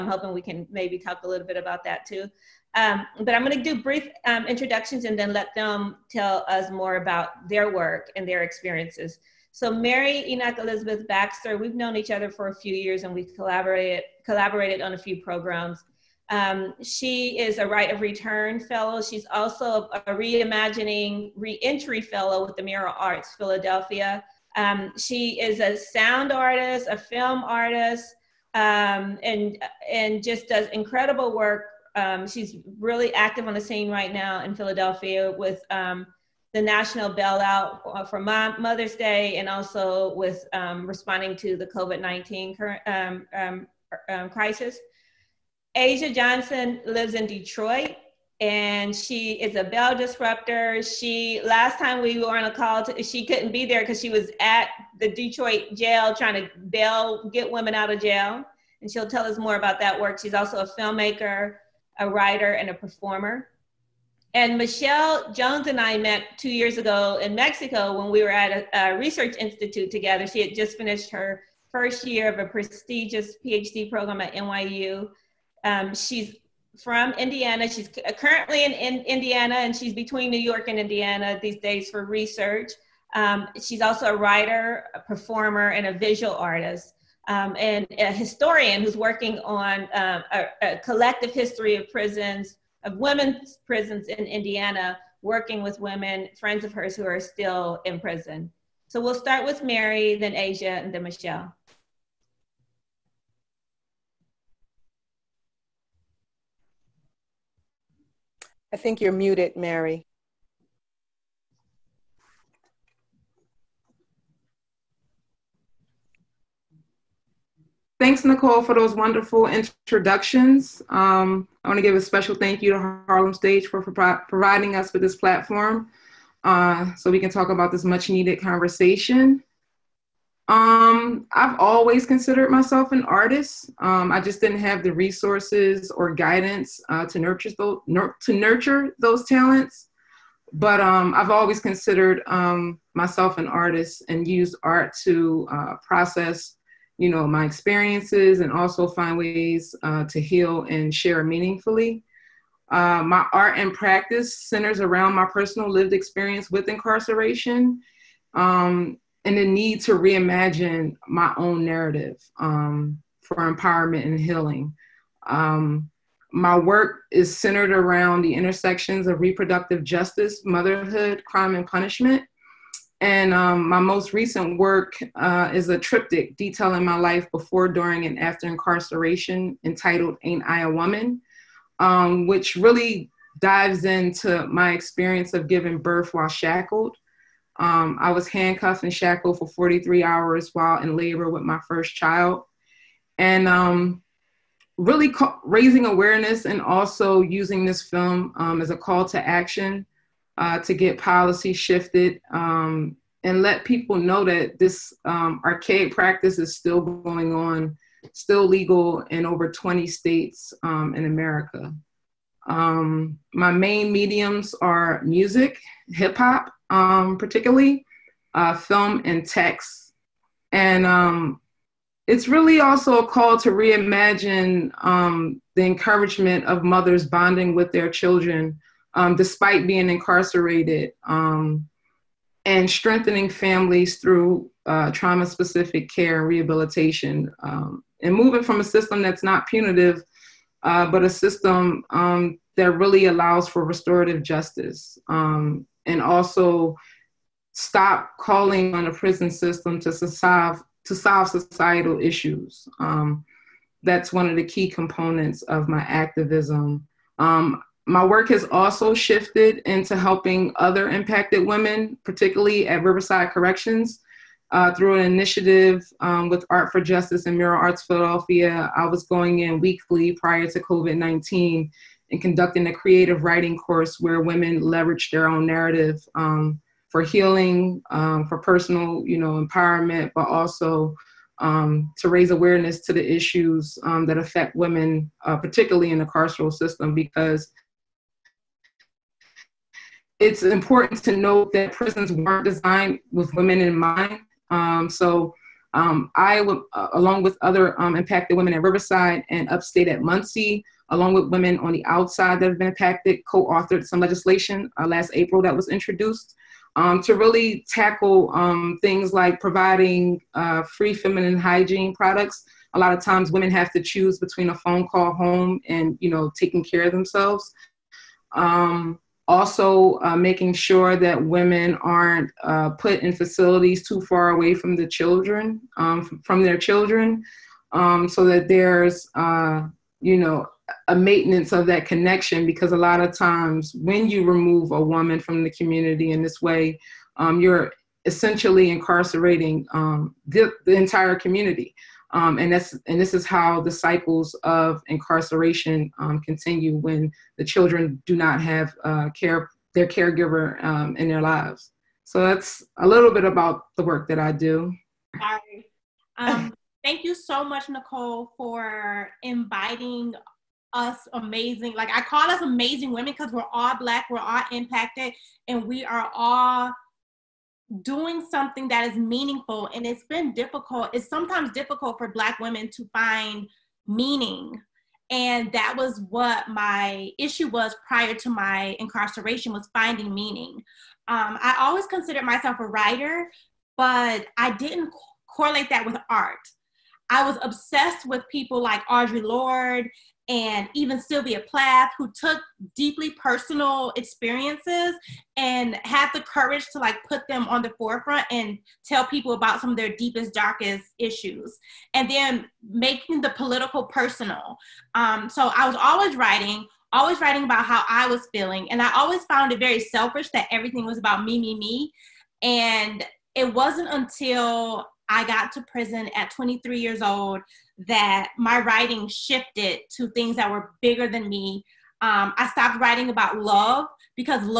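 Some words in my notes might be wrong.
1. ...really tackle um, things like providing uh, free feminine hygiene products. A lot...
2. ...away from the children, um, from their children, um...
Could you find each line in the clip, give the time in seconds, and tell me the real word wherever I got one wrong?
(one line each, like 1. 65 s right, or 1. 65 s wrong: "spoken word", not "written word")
1. 307 s right
2. 324 s right.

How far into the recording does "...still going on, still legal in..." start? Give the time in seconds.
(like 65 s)
206 s.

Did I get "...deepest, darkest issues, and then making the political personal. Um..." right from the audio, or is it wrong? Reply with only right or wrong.
right.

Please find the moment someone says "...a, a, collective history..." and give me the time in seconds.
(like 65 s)
90 s.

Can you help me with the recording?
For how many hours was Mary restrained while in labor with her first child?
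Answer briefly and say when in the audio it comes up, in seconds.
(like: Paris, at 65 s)
43, at 189 s.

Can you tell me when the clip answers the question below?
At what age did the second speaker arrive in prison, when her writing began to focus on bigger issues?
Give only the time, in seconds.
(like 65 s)
416 s.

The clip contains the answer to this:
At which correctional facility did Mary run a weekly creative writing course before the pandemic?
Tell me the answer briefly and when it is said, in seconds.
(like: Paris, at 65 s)
Riverside Corrections, at 262 s.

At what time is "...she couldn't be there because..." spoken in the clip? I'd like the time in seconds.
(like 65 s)
53 s.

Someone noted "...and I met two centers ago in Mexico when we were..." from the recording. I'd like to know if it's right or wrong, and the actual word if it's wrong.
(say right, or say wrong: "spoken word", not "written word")
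wrong: "years", not "centers".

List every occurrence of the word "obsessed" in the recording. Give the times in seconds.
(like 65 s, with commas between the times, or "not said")
387 s.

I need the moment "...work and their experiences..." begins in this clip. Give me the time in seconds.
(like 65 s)
7 s.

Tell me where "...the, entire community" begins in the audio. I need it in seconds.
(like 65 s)
340 s.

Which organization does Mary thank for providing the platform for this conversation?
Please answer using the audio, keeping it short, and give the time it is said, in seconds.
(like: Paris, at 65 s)
Harlem Stage, at 123 s.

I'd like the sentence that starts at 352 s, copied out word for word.
So that's a little bit about the work that I do.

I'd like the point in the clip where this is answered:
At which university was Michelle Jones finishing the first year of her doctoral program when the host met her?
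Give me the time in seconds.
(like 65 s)
74 s.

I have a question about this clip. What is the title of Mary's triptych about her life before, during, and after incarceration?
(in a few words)
Ain't I a Woman.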